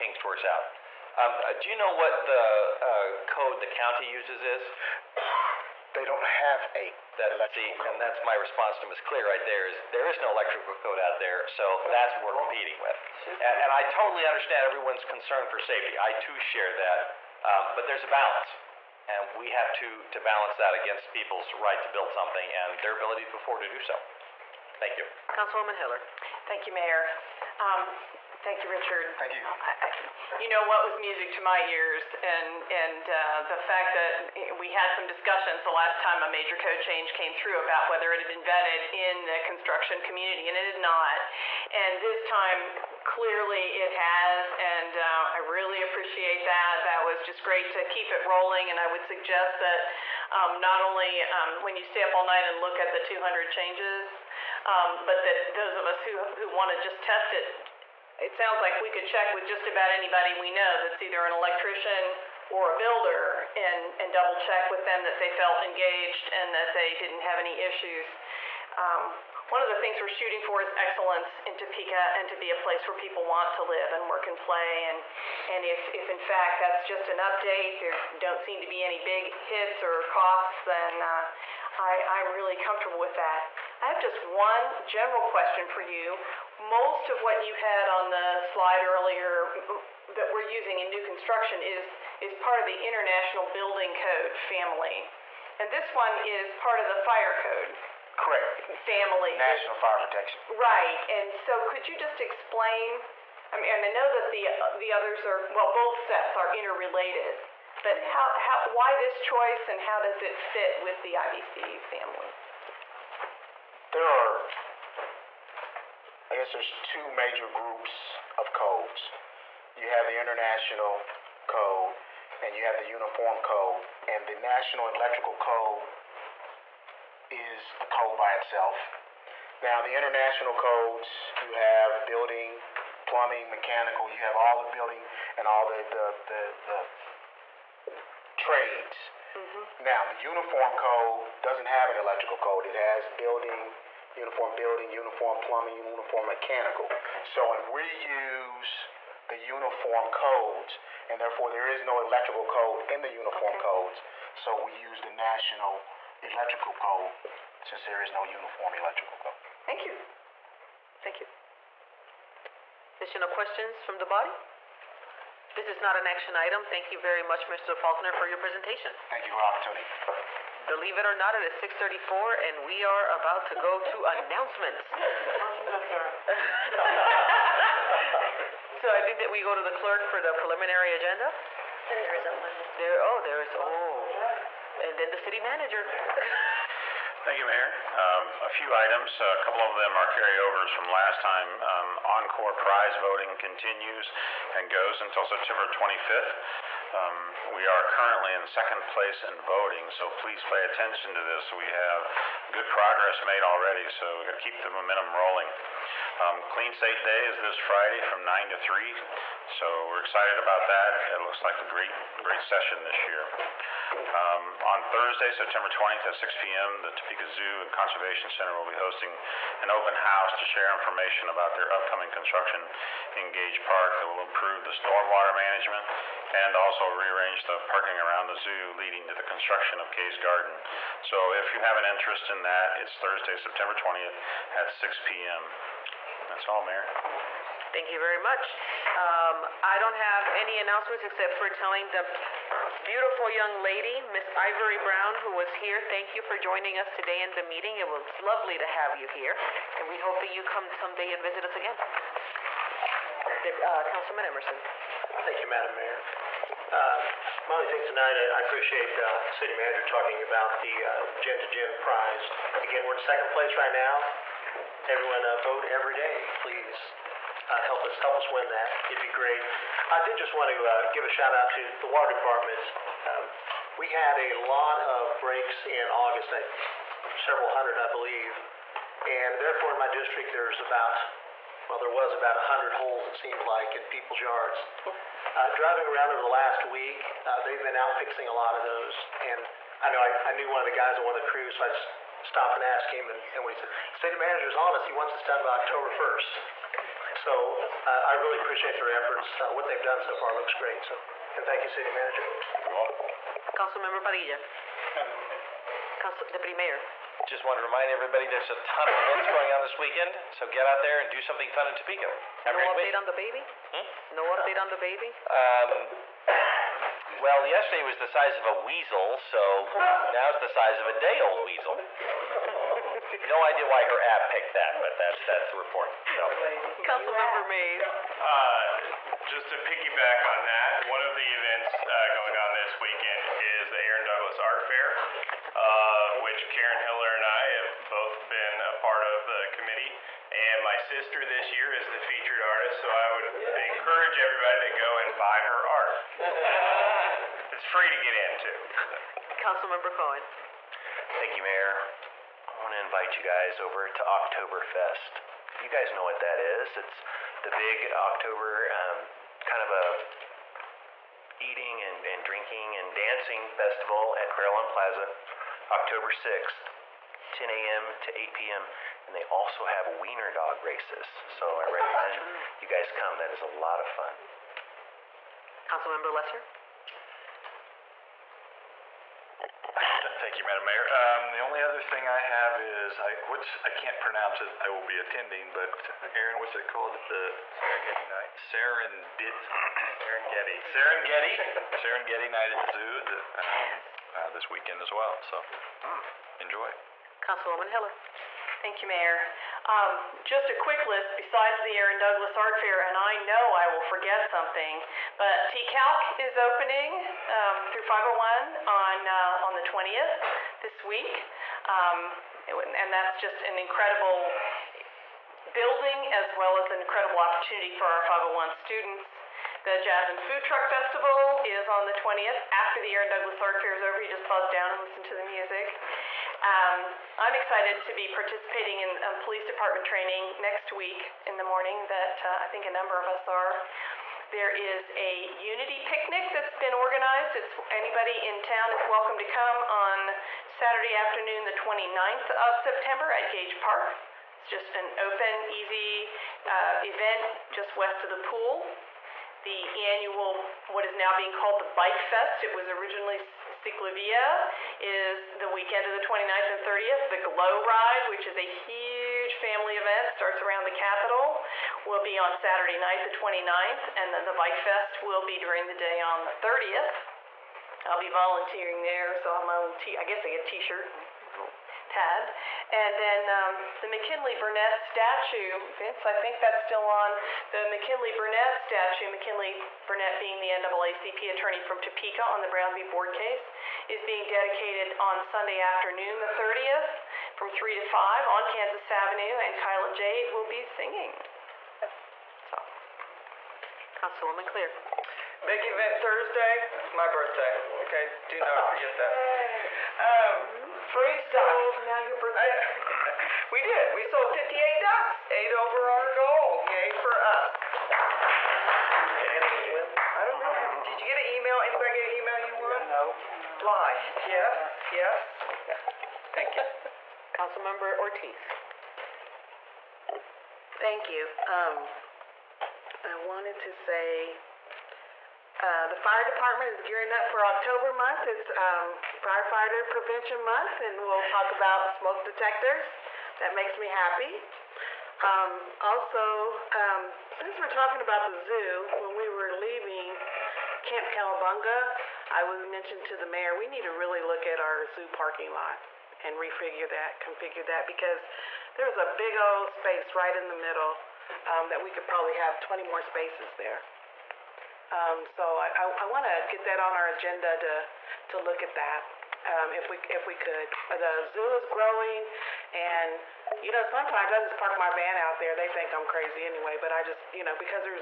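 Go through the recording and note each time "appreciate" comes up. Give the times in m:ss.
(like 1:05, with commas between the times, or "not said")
0:45, 4:18, 4:58.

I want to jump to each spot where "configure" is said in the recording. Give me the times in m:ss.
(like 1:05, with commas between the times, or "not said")
9:07.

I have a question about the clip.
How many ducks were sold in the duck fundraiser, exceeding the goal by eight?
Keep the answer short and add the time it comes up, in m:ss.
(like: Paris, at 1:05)
58, at 8:24.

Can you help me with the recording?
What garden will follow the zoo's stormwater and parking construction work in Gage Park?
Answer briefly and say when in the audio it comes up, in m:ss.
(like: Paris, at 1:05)
Kay's Garden, at 3:49.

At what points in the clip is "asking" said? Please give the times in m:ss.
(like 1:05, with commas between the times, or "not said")
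not said.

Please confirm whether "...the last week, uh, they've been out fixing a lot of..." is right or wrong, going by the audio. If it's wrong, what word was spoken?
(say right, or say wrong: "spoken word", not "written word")
right.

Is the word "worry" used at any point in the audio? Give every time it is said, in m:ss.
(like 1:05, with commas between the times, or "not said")
not said.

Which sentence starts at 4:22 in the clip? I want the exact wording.
Again, we're in second place right now.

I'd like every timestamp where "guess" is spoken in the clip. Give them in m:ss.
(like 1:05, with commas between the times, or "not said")
1:56, 7:50.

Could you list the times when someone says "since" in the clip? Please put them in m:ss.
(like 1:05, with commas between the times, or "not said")
2:37, 8:57.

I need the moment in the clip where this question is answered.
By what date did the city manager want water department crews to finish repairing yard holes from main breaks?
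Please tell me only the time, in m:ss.
4:55.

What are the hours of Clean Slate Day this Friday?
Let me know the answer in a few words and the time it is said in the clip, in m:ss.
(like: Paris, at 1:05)
9 to 3, at 3:28.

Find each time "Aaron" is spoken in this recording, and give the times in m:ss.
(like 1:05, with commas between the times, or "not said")
5:33, 6:26, 6:41, 7:02.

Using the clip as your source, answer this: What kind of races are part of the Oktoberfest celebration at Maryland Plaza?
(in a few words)
wiener dog races.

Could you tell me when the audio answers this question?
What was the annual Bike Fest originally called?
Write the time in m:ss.
7:33.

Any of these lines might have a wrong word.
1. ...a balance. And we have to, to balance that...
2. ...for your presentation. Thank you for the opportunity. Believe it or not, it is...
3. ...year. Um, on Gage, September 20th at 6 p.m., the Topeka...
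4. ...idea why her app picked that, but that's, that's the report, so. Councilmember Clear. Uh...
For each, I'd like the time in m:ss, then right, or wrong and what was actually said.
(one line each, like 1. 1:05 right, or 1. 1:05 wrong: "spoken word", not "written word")
1. 0:18 right
2. 2:48 right
3. 3:33 wrong: "Thursday", not "Gage"
4. 5:23 wrong: "Mays", not "Clear".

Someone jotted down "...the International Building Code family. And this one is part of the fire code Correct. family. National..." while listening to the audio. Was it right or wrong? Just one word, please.
right.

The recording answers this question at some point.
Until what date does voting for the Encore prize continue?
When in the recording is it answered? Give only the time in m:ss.
3:15.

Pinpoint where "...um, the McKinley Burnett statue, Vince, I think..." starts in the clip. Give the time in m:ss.
7:53.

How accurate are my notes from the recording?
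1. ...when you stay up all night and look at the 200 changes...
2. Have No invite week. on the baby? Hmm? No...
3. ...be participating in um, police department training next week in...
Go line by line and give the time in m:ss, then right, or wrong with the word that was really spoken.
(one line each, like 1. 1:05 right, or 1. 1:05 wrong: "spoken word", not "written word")
1. 0:51 right
2. 5:12 wrong: "update", not "invite"
3. 7:07 right.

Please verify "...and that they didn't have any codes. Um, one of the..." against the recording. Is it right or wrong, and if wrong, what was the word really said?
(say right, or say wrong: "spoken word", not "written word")
wrong: "issues", not "codes".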